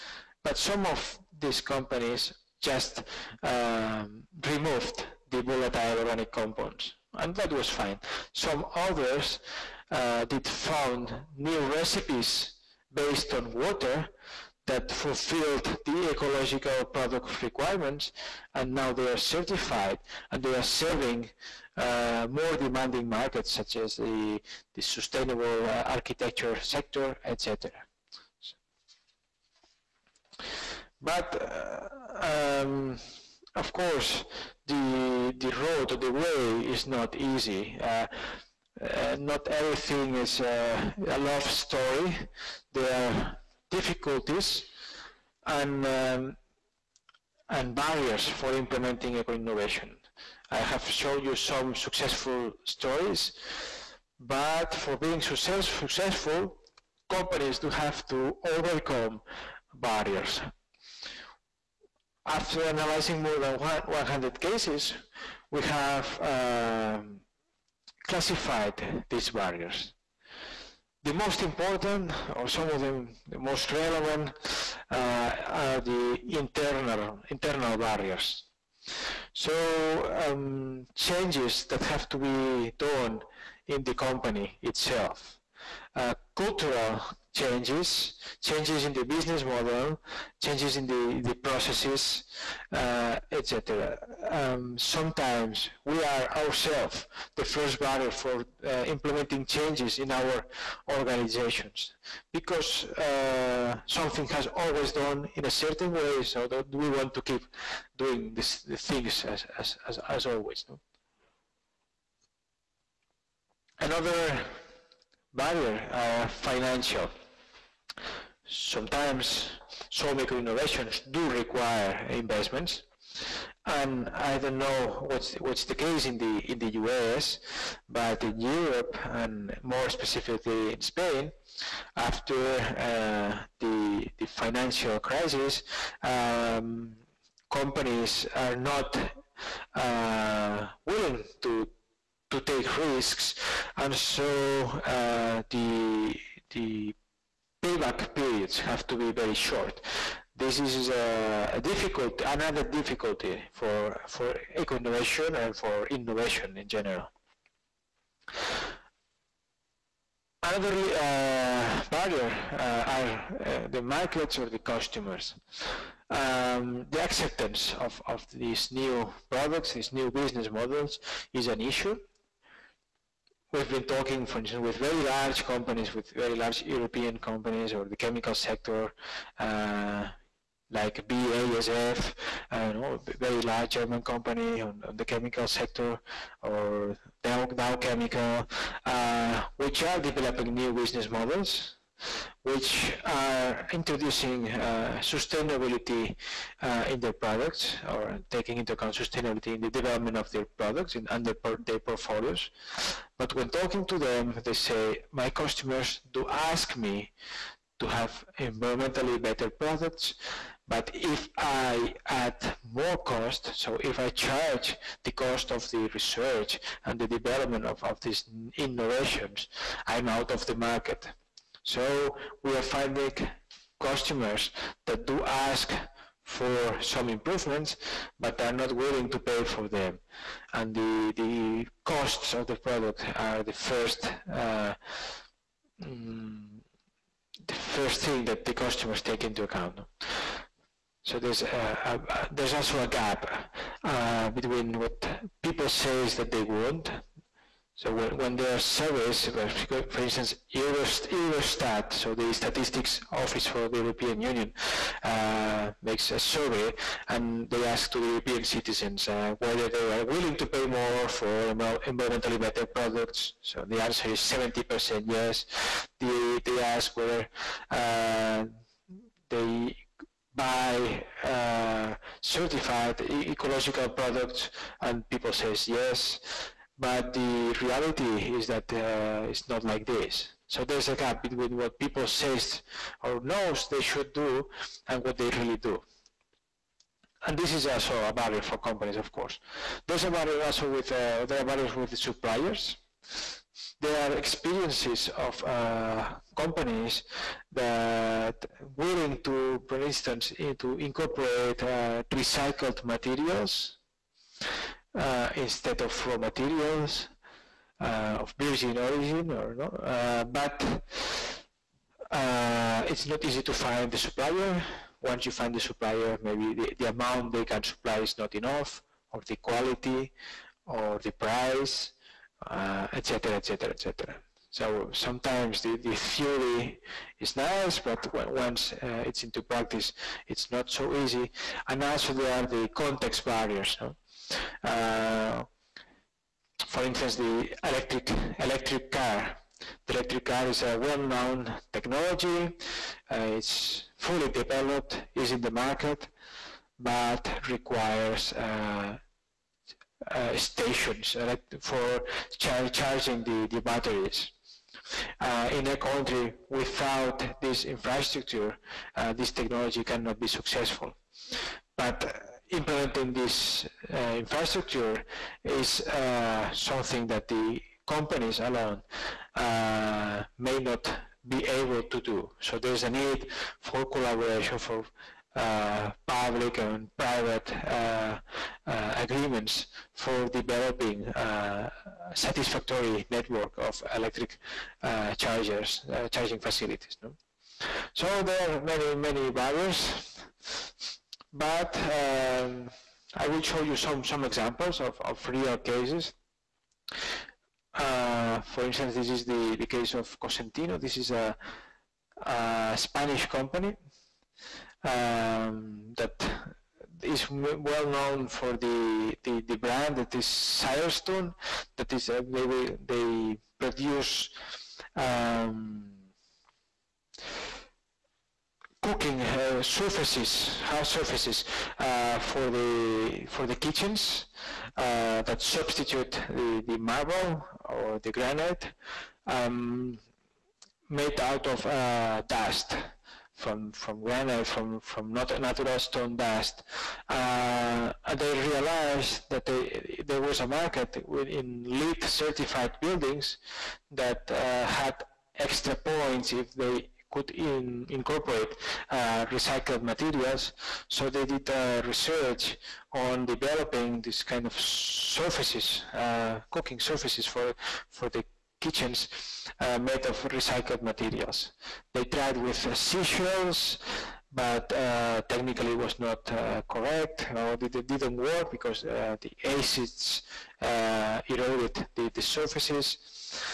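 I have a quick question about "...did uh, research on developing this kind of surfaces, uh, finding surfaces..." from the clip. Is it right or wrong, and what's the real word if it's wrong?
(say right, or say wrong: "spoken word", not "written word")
wrong: "cooking", not "finding".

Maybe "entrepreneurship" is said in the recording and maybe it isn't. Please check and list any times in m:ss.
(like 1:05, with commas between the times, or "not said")
not said.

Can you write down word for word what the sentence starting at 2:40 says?
Another uh, barrier uh, are uh, the markets or the customers.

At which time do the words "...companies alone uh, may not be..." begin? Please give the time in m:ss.
6:07.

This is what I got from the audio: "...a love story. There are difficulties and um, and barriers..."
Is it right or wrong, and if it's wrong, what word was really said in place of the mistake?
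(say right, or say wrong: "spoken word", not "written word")
right.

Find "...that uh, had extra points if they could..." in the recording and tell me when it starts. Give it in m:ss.
7:23.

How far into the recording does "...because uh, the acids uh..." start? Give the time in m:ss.
7:48.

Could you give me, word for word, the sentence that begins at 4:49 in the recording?
There's a barrier also with, uh, there are barriers with the suppliers.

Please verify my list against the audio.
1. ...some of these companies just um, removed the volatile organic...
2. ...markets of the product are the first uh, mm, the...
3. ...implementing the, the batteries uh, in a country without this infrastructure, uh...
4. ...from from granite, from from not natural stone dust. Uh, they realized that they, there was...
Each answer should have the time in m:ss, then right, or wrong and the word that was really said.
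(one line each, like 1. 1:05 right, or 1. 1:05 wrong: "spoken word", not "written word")
1. 0:00 right
2. 3:51 wrong: "costs", not "markets"
3. 5:52 wrong: "charging", not "implementing"
4. 7:13 right.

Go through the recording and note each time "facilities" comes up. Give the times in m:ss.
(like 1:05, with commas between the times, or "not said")
6:26.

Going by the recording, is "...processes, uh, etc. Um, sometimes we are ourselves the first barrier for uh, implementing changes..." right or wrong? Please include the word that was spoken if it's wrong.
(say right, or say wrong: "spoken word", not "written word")
right.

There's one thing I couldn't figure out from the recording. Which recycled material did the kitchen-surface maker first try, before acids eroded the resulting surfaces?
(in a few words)
Seashells.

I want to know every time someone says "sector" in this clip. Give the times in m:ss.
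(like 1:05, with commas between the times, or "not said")
0:26, 2:58, 3:05.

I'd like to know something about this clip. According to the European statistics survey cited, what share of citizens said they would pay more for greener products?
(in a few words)
70%.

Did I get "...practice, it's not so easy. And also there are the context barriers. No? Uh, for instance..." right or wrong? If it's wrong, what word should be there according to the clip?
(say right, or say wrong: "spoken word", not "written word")
right.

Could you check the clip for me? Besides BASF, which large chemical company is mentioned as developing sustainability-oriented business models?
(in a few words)
Dow Chemical.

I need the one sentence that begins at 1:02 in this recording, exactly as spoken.
After analyzing more than 100 cases, we have uh, classified these barriers.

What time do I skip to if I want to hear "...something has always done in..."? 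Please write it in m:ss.
1:43.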